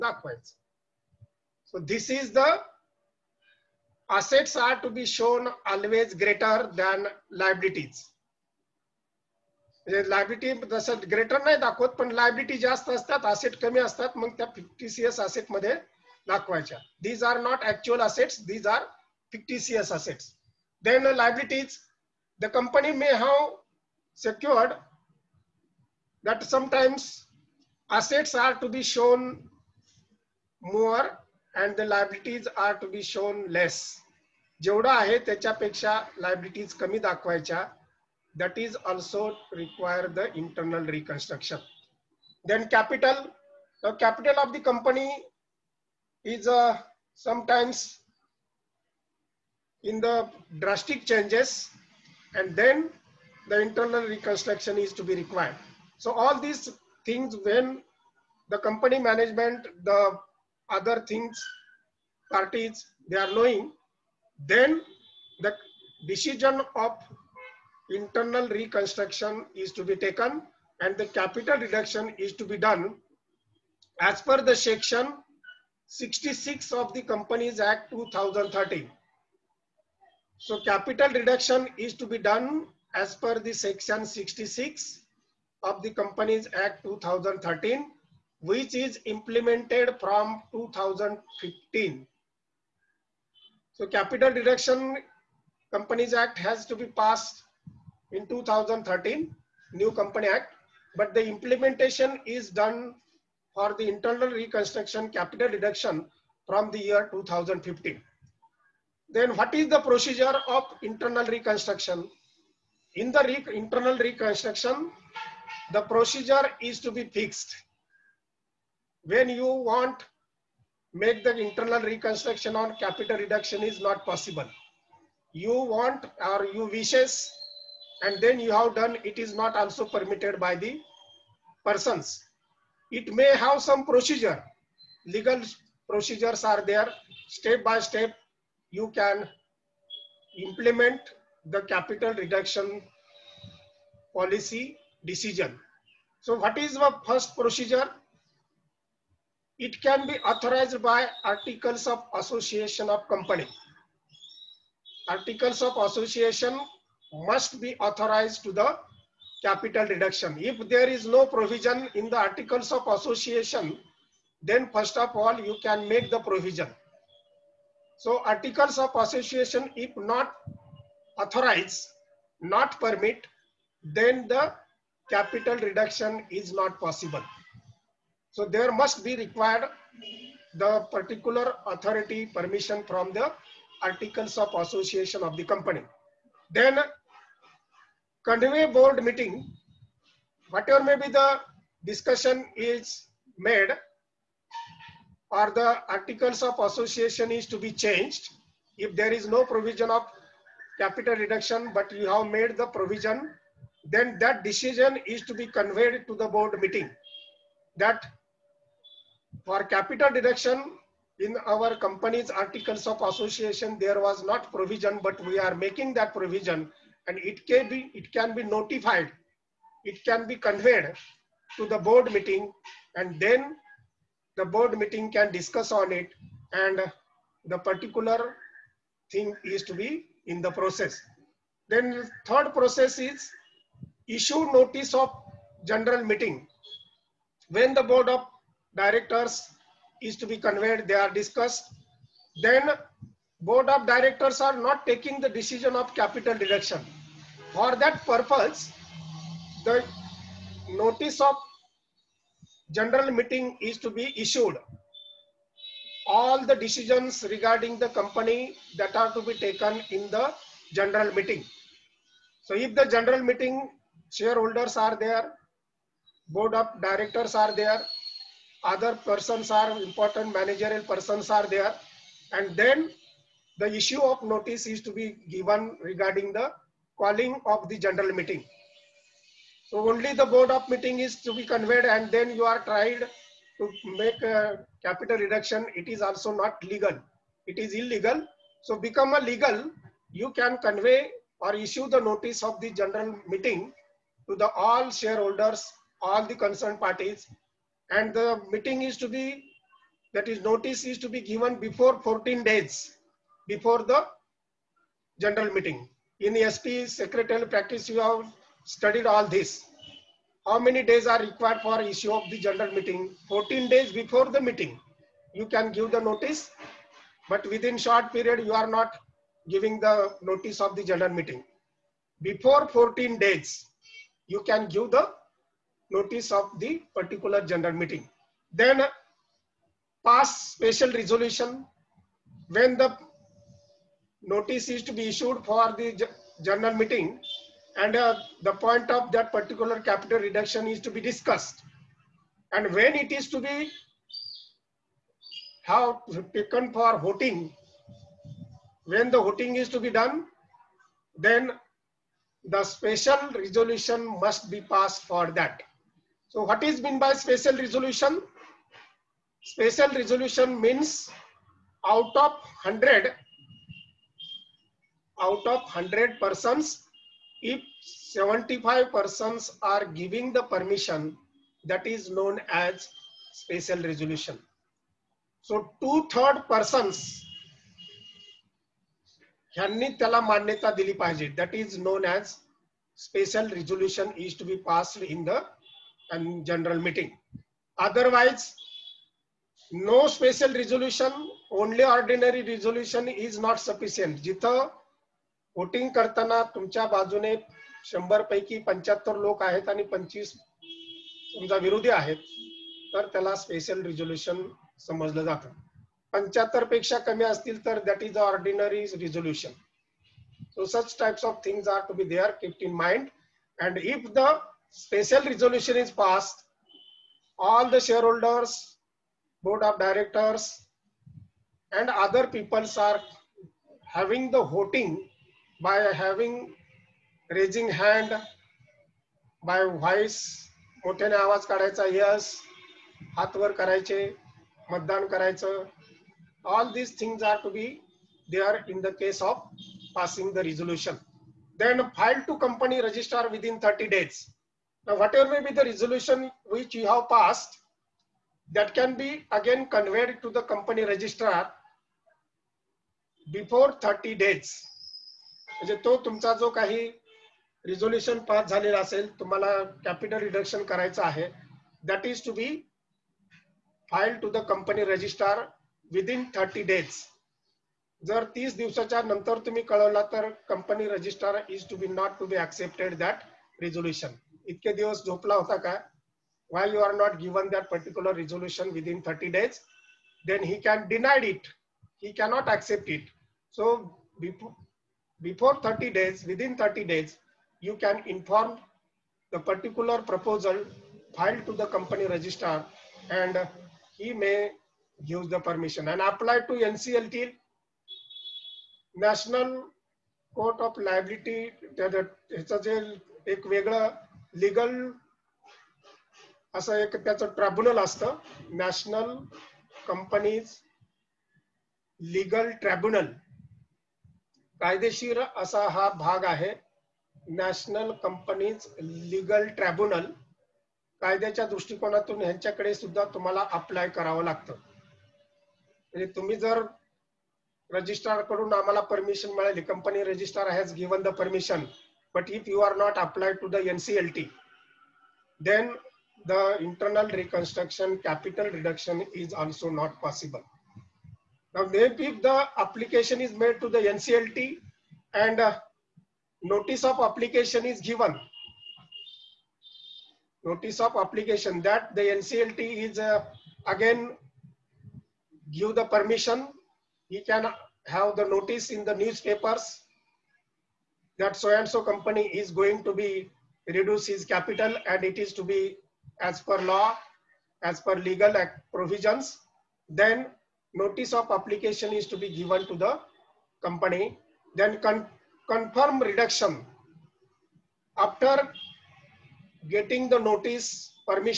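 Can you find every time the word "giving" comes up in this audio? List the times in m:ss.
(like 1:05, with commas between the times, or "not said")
5:19, 6:10.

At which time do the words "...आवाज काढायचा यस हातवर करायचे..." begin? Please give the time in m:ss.
7:11.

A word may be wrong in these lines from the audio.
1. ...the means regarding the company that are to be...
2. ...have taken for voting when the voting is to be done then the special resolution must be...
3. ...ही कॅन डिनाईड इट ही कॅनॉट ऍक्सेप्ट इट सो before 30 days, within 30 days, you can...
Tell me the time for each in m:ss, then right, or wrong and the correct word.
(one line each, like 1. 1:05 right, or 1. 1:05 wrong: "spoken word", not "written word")
1. 4:16 wrong: "decisions", not "means"
2. 5:45 right
3. 8:00 right.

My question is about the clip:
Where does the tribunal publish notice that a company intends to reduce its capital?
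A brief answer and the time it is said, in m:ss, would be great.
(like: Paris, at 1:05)
Newspapers, at 9:18.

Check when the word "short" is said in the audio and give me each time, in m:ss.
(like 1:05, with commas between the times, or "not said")
5:17.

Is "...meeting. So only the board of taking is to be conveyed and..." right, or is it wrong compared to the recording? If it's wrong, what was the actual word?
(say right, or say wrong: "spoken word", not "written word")
wrong: "meeting", not "taking".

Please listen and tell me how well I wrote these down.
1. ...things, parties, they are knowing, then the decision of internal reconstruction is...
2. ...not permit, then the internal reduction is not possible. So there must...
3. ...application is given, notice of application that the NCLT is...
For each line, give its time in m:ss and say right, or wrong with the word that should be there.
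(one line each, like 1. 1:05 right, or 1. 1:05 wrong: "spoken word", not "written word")
1. 1:01 right
2. 2:52 wrong: "capital", not "internal"
3. 9:06 right.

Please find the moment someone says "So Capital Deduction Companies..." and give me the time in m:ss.
1:33.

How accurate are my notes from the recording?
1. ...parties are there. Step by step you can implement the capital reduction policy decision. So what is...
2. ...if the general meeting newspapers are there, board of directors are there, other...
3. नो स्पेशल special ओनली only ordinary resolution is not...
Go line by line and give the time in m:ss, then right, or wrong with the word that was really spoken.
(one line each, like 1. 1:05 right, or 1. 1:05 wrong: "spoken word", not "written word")
1. 2:15 wrong: "procedures", not "parties"
2. 4:22 wrong: "shareholders", not "newspapers"
3. 6:29 right.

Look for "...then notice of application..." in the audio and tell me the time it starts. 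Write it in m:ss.
9:29.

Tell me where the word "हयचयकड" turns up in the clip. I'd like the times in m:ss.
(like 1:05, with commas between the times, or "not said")
8:42.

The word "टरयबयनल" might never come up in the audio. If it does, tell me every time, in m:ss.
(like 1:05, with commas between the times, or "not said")
8:27, 8:32, 8:39.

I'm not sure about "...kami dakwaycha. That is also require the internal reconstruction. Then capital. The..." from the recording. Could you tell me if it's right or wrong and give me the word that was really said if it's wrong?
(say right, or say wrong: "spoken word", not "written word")
right.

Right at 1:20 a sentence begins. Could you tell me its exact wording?
So capital reduction is to be done as per the section 66 of the Companies Act 2013 which is implemented from 2015.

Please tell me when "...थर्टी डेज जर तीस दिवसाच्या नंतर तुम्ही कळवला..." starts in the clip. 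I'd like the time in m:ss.
7:46.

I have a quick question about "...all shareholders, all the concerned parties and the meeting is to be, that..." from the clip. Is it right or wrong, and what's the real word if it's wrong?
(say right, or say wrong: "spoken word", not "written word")
right.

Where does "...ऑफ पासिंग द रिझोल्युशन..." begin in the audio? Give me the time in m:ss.
7:19.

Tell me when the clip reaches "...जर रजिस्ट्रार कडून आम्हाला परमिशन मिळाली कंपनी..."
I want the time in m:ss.
8:46.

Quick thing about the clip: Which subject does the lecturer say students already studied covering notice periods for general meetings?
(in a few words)
Secretarial practice.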